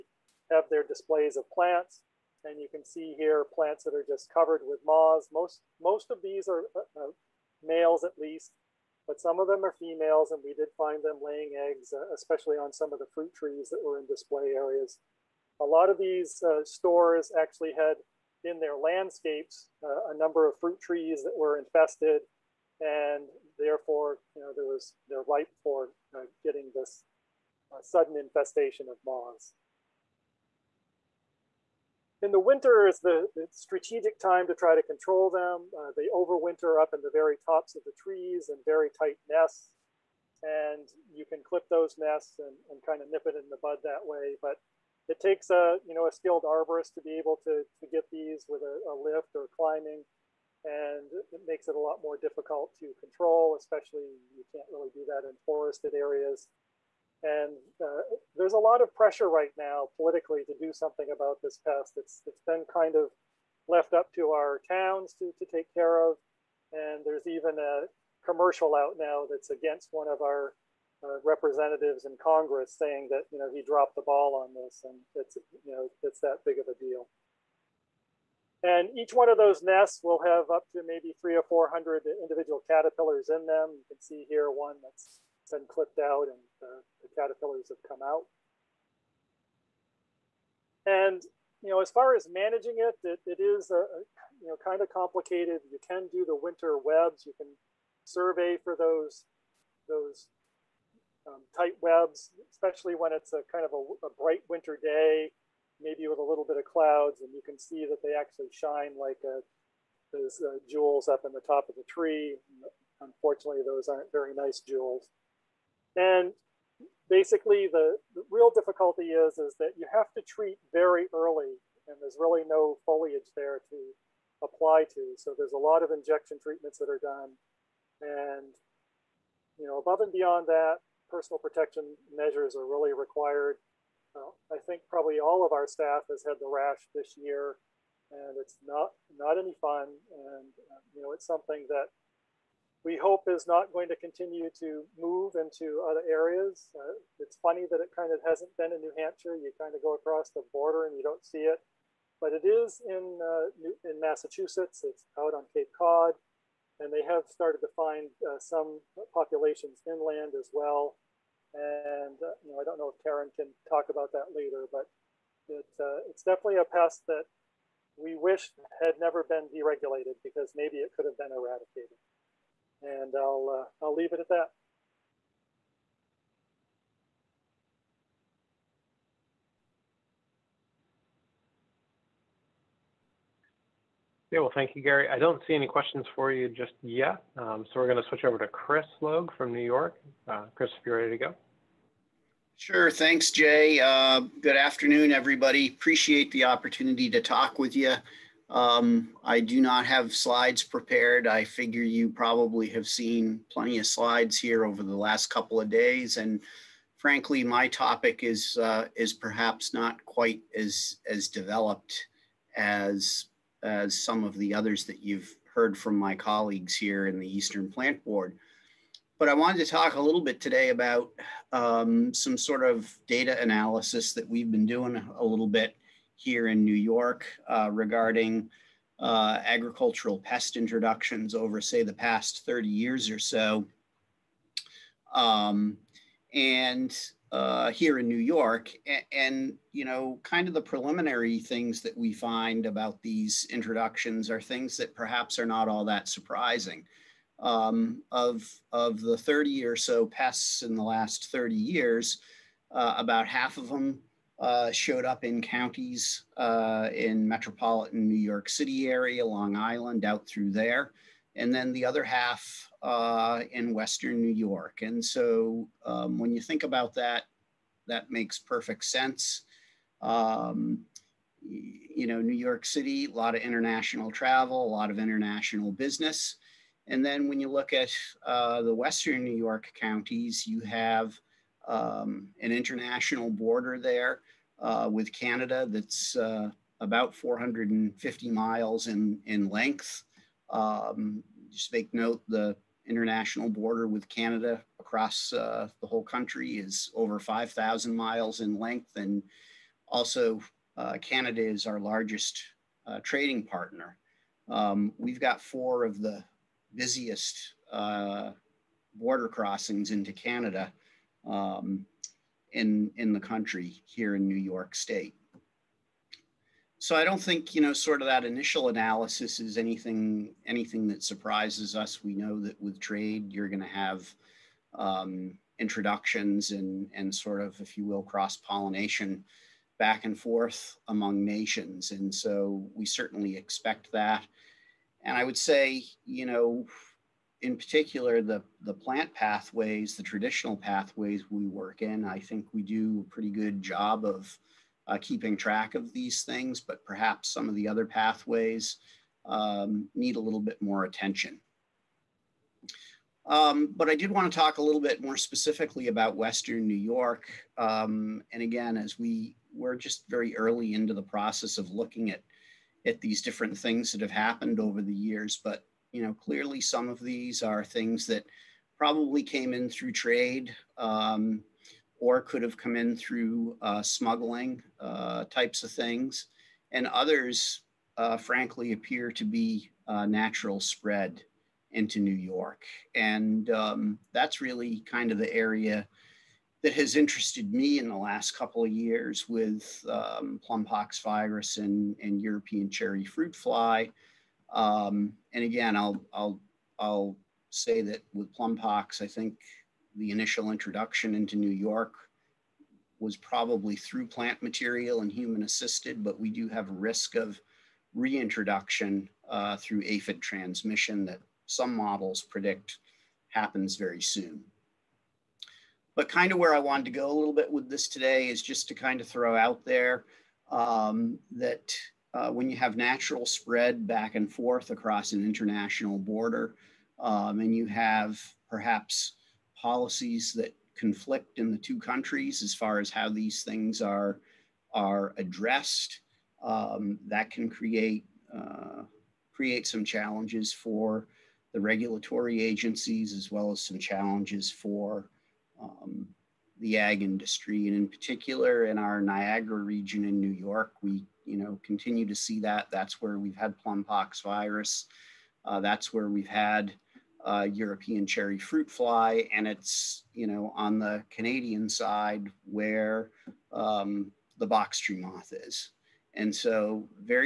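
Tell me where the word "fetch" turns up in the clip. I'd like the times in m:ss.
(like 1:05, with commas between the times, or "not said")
not said.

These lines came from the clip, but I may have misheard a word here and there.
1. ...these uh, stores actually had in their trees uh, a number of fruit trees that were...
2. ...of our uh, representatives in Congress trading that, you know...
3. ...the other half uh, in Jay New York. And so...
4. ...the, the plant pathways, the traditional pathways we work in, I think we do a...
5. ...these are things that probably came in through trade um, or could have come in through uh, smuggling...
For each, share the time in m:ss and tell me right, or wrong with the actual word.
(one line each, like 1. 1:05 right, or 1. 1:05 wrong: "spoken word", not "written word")
1. 0:15 wrong: "landscapes", not "trees"
2. 1:10 wrong: "saying", not "trading"
3. 4:21 wrong: "Western", not "Jay"
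4. 5:38 right
5. 6:06 right.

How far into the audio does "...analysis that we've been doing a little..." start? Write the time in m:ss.
3:43.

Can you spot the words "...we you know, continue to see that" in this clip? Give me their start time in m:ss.
7:30.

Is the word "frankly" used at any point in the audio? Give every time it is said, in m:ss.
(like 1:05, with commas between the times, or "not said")
3:26, 6:18.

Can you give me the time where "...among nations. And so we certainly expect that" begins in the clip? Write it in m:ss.
5:30.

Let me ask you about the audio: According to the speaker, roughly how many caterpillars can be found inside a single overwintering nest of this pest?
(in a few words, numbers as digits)
300 or 400.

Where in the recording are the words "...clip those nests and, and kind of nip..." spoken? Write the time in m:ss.
0:41.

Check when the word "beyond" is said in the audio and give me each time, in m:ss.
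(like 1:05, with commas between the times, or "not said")
2:10.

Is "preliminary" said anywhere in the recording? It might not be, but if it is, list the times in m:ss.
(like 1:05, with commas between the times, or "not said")
4:00.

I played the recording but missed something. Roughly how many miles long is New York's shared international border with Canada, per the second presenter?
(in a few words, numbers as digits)
450 miles.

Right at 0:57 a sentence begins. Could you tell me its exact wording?
And uh, there's a lot of pressure right now politically to do something about this pest.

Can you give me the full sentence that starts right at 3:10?
Uh, Chris, if you're ready to go.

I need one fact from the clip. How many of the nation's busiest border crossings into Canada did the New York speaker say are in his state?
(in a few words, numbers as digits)
4.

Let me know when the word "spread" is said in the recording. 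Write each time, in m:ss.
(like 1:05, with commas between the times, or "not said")
6:20, 7:03.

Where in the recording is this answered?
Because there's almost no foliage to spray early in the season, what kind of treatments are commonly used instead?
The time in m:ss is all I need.
2:05.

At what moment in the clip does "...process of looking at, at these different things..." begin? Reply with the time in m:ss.
6:01.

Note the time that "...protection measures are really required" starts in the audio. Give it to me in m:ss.
2:11.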